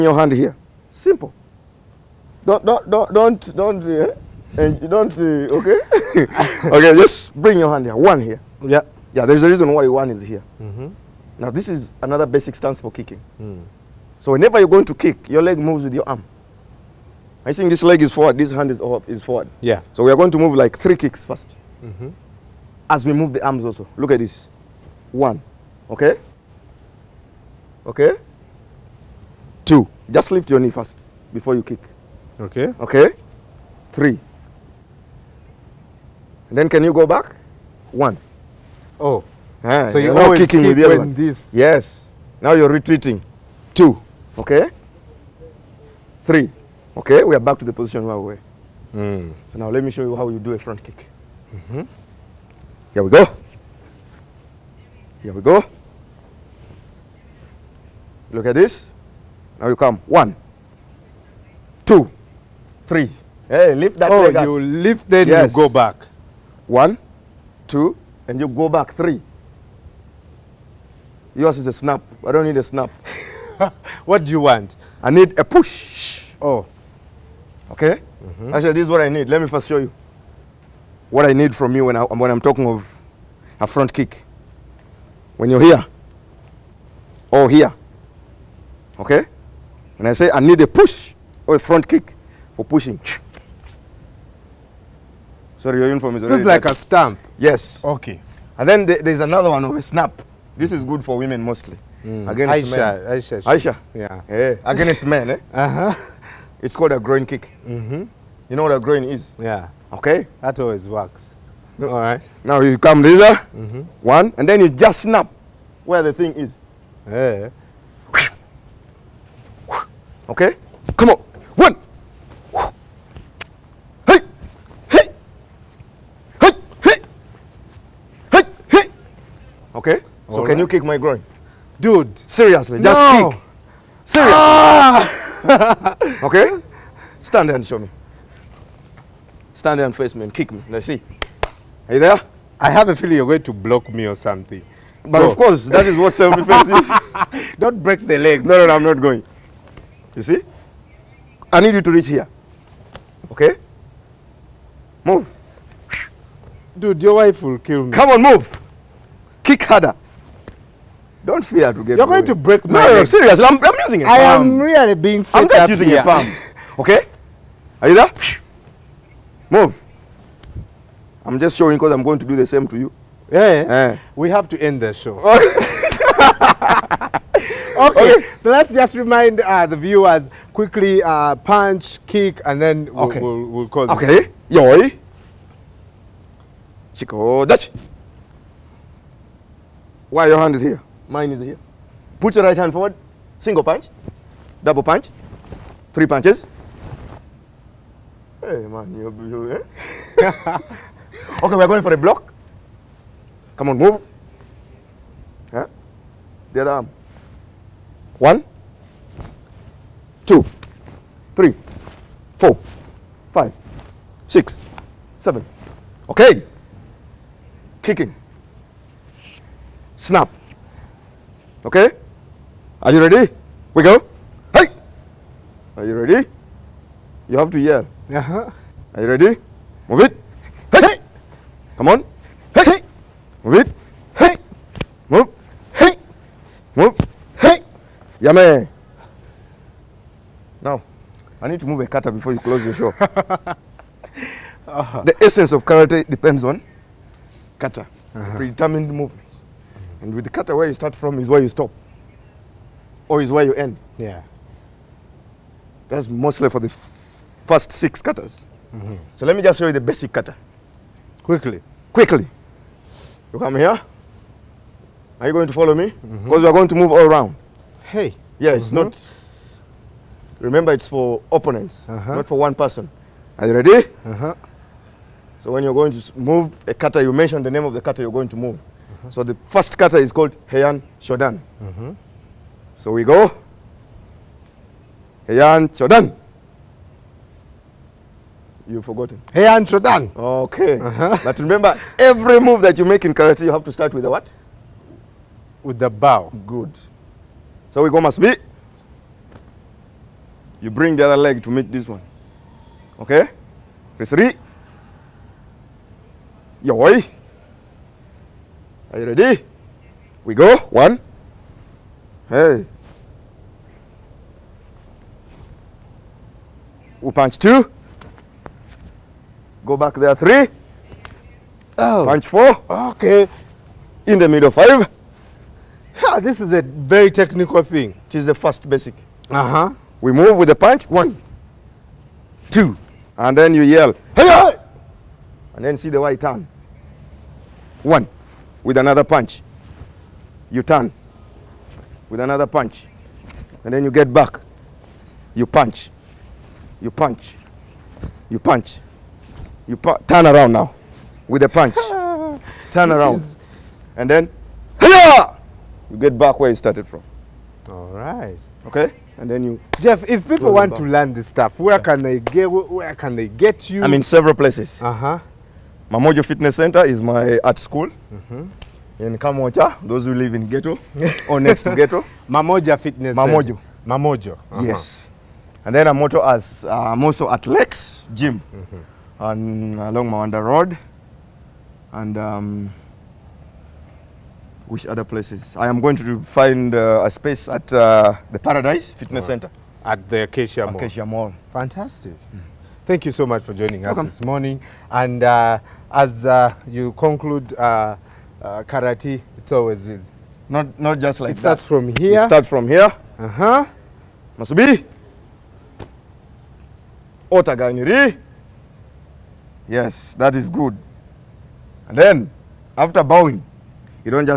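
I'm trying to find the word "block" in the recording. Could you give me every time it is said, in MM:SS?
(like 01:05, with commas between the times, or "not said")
02:23, 03:21.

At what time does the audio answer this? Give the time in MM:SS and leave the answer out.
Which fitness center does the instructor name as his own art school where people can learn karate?
06:05.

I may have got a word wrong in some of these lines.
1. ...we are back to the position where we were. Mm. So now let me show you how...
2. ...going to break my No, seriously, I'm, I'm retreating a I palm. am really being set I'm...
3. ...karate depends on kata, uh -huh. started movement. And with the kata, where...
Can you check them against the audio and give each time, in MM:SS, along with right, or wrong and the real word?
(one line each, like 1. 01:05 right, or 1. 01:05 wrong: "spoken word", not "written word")
1. 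00:47 right
2. 02:42 wrong: "using", not "retreating"
3. 04:05 wrong: "predetermined", not "started".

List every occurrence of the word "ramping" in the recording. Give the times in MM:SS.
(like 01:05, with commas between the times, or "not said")
not said.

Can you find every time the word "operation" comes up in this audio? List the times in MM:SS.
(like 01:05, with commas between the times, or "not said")
not said.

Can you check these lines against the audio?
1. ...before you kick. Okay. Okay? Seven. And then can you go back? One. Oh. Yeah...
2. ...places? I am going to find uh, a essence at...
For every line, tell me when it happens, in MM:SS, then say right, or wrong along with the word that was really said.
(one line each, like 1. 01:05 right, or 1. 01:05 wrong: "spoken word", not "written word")
1. 00:31 wrong: "Three", not "Seven"
2. 06:25 wrong: "space", not "essence".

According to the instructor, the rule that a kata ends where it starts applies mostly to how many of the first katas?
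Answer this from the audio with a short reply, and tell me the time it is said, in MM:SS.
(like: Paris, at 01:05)
6, at 04:17.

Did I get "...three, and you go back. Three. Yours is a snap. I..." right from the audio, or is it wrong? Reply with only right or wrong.
wrong.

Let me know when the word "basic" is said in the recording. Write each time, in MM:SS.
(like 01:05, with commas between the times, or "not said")
00:12, 04:19, 05:28.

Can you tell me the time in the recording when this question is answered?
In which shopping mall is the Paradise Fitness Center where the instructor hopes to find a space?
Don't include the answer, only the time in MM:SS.
06:30.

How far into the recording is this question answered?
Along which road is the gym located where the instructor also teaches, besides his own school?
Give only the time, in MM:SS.
06:20.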